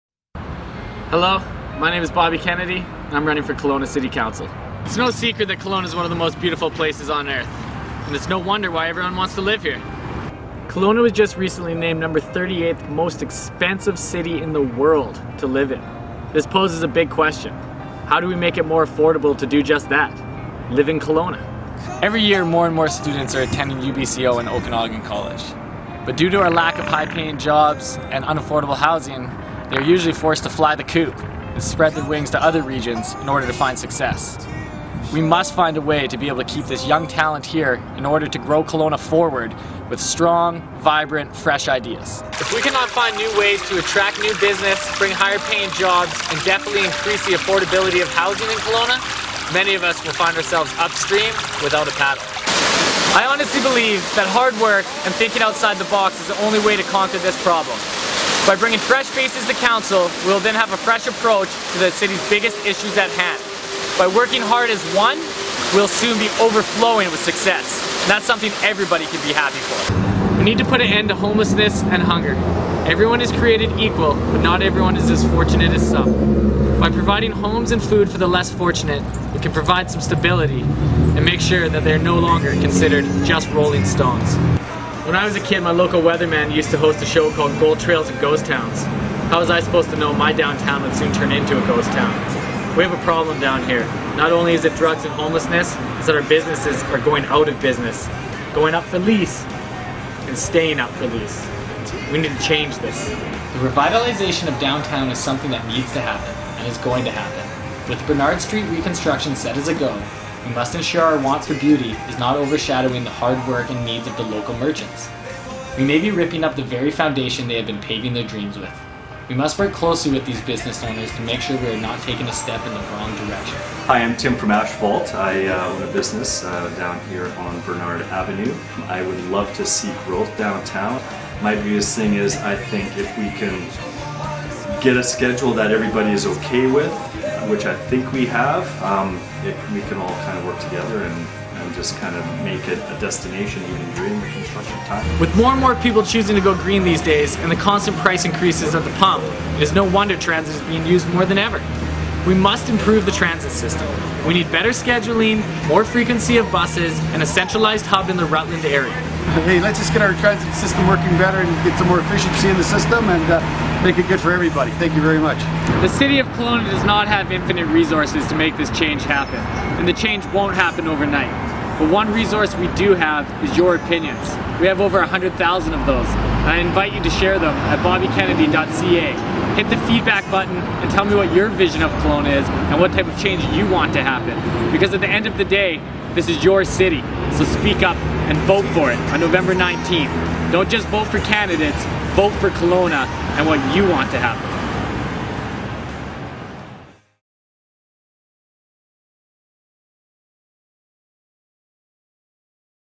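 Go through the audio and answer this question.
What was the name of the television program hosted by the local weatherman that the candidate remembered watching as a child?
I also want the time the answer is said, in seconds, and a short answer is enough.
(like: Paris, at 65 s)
Gold Trails and Ghost Towns, at 87 s.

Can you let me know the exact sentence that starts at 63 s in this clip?
By working hard as one, we'll soon be overflowing with success.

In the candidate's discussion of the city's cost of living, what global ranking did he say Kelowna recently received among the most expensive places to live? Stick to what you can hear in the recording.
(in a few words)
38th.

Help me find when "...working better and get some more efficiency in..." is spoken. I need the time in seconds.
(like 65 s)
160 s.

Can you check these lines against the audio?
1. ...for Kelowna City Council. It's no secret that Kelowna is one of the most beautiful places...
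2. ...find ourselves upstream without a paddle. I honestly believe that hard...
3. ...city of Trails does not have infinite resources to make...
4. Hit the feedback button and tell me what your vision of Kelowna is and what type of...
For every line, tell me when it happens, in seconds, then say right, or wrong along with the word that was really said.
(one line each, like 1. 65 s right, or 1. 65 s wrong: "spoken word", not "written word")
1. 3 s right
2. 50 s right
3. 165 s wrong: "Kelowna", not "Trails"
4. 179 s right.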